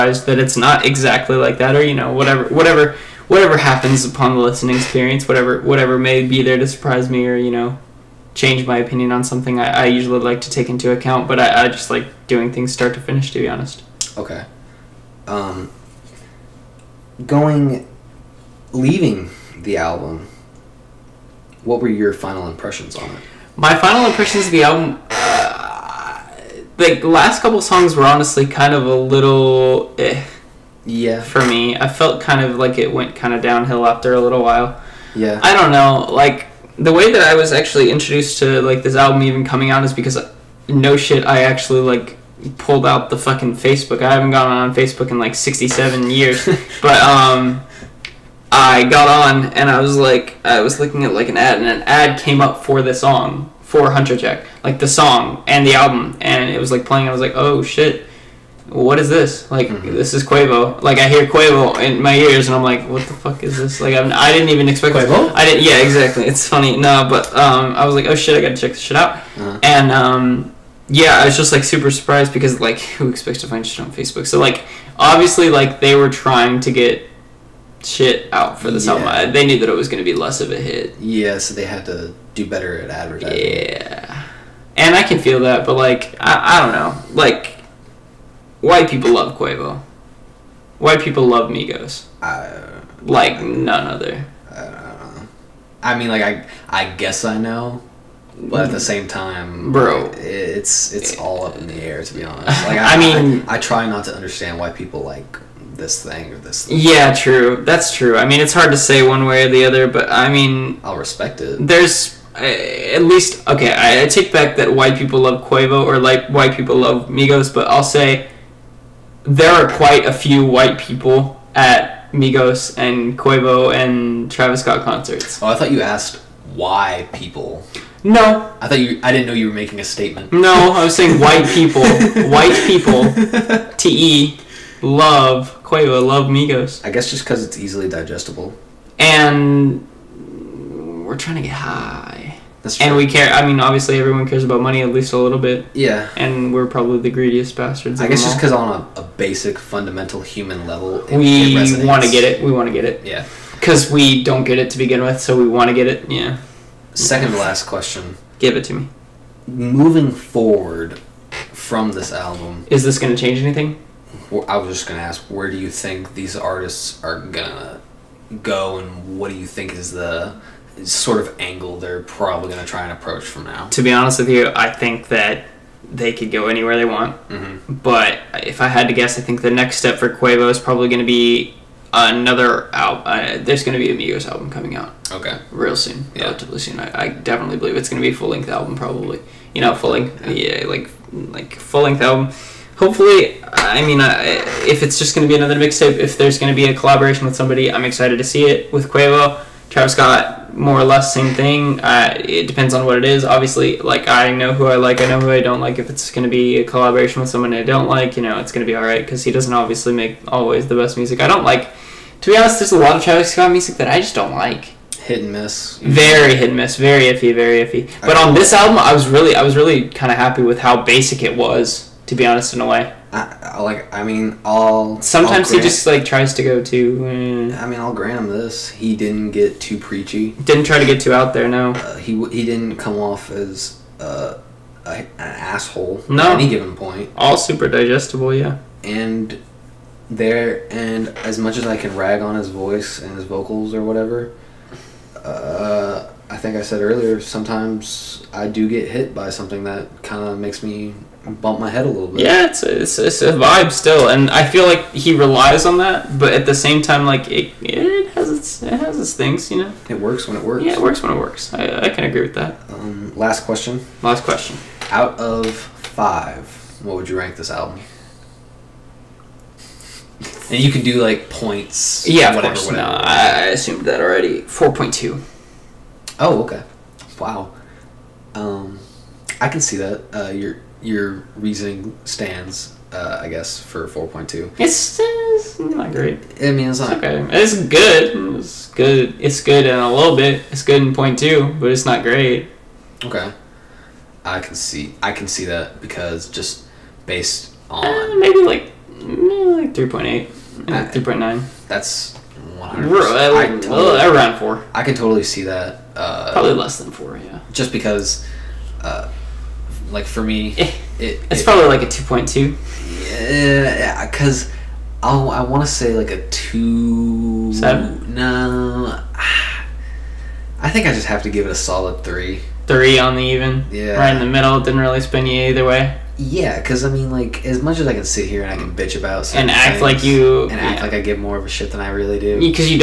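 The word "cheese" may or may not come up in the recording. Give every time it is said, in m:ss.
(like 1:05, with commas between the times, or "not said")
not said.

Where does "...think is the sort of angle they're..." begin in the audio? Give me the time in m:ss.
2:49.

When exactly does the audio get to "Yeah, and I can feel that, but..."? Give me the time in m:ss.
1:23.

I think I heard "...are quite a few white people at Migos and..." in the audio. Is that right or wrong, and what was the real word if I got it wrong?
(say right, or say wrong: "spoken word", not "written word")
right.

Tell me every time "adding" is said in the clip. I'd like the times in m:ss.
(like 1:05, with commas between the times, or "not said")
not said.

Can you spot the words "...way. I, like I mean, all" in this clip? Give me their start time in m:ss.
3:42.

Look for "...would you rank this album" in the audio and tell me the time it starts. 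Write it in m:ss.
4:26.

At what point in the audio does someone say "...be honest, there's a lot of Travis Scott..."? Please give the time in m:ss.
3:32.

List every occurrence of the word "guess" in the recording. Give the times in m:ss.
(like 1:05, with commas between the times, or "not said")
1:36, 2:16, 2:28, 2:58, 4:43.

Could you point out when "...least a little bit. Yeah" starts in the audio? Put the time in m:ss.
2:24.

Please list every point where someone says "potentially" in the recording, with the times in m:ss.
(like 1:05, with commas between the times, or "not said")
not said.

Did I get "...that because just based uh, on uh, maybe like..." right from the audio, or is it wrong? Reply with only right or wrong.
right.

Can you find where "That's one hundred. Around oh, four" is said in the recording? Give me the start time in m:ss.
5:01.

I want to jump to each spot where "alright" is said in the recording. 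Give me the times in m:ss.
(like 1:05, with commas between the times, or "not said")
3:28.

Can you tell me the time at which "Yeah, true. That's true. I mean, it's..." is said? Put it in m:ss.
1:46.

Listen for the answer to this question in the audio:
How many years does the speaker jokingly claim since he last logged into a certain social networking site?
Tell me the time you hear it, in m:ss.
0:45.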